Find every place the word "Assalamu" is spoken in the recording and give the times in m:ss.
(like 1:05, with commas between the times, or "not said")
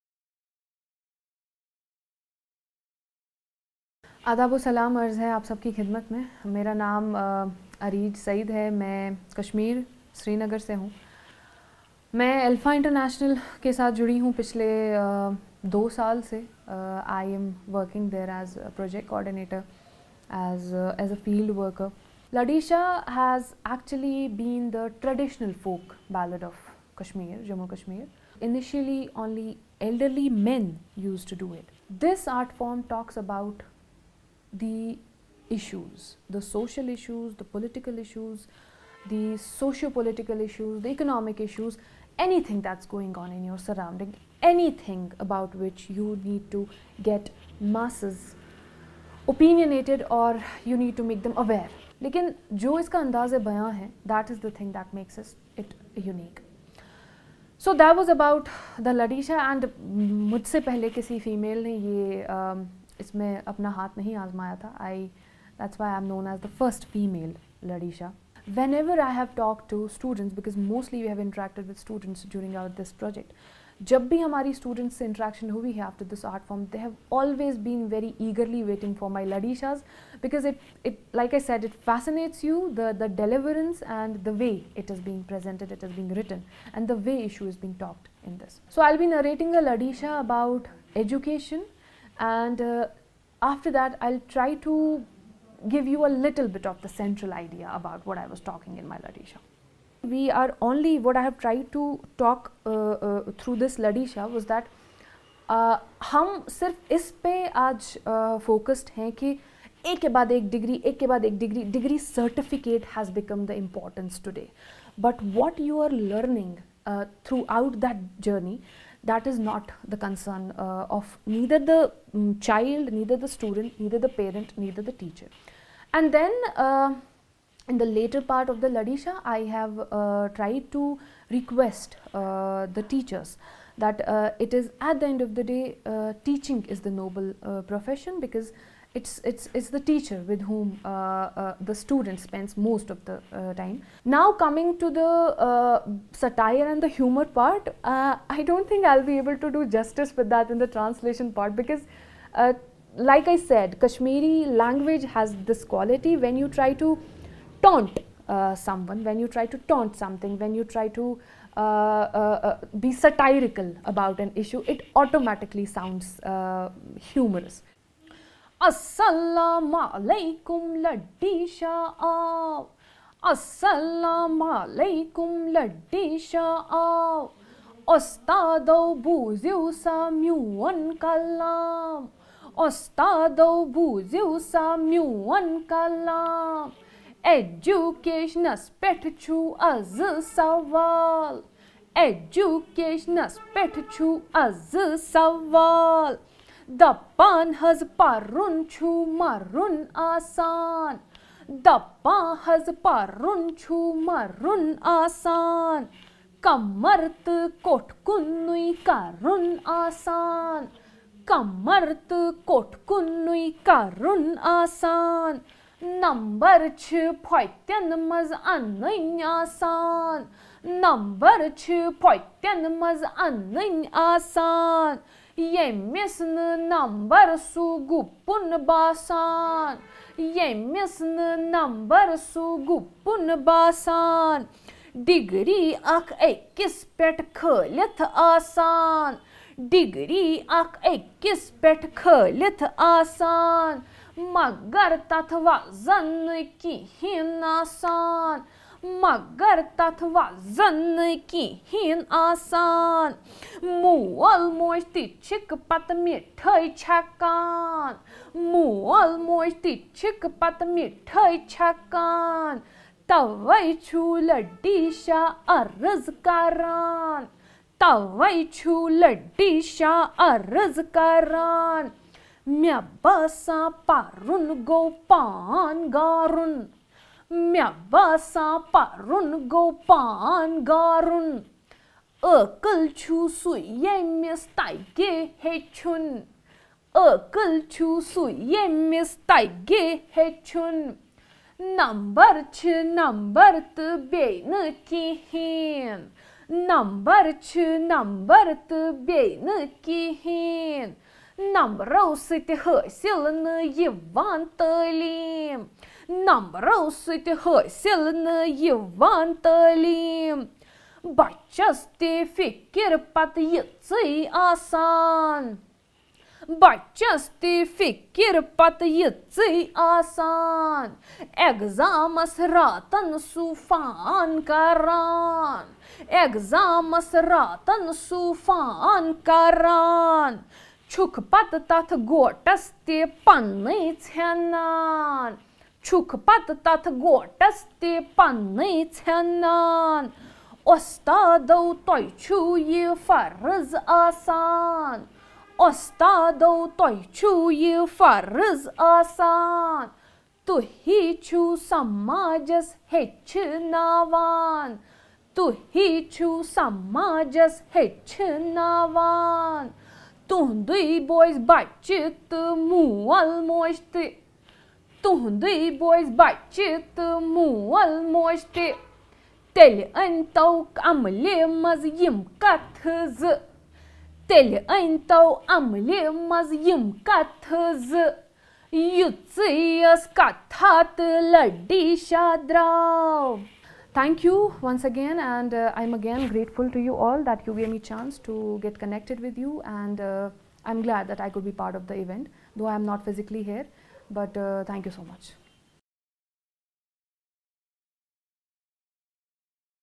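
2:48, 2:53.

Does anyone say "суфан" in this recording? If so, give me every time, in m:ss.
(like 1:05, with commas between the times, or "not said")
5:23, 5:27.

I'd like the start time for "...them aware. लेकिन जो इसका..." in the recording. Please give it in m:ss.
0:51.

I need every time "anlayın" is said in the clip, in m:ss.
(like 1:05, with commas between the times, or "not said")
3:38, 3:43.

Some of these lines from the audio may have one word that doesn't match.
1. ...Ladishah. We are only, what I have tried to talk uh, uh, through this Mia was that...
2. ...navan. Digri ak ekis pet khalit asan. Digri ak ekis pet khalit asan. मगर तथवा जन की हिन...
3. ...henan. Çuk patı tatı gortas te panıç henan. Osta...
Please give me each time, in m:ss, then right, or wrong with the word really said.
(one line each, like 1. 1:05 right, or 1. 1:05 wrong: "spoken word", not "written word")
1. 1:38 wrong: "Ladishah", not "Mia"
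2. 3:53 wrong: "basan", not "navan"
3. 5:34 right.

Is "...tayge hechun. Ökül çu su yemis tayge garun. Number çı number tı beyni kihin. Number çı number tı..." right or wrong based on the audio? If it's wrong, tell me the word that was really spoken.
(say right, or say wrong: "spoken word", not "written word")
wrong: "hechun", not "garun".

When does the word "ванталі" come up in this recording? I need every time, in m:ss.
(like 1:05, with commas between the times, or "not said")
5:04, 5:08.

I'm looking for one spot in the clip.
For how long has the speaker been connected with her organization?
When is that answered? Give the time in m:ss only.
0:15.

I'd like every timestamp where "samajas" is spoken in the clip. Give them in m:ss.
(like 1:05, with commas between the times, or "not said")
5:51, 5:56.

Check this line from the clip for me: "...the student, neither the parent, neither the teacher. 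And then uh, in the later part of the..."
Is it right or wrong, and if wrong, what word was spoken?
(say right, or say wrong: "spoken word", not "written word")
right.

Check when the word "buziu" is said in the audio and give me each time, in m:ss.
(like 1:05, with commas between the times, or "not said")
2:59, 3:03.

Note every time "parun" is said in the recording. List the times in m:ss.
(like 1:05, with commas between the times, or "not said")
4:33, 4:38.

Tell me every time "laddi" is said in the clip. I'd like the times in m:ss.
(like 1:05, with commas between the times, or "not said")
2:50, 2:55.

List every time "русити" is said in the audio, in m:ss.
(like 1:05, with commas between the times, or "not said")
5:01, 5:06.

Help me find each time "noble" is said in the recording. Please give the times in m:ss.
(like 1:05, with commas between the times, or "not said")
2:17.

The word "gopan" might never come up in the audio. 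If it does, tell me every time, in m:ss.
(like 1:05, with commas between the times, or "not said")
4:34, 4:39.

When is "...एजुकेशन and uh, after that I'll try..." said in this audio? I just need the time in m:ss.
1:30.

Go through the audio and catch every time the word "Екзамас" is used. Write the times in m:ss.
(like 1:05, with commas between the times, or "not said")
5:21, 5:26.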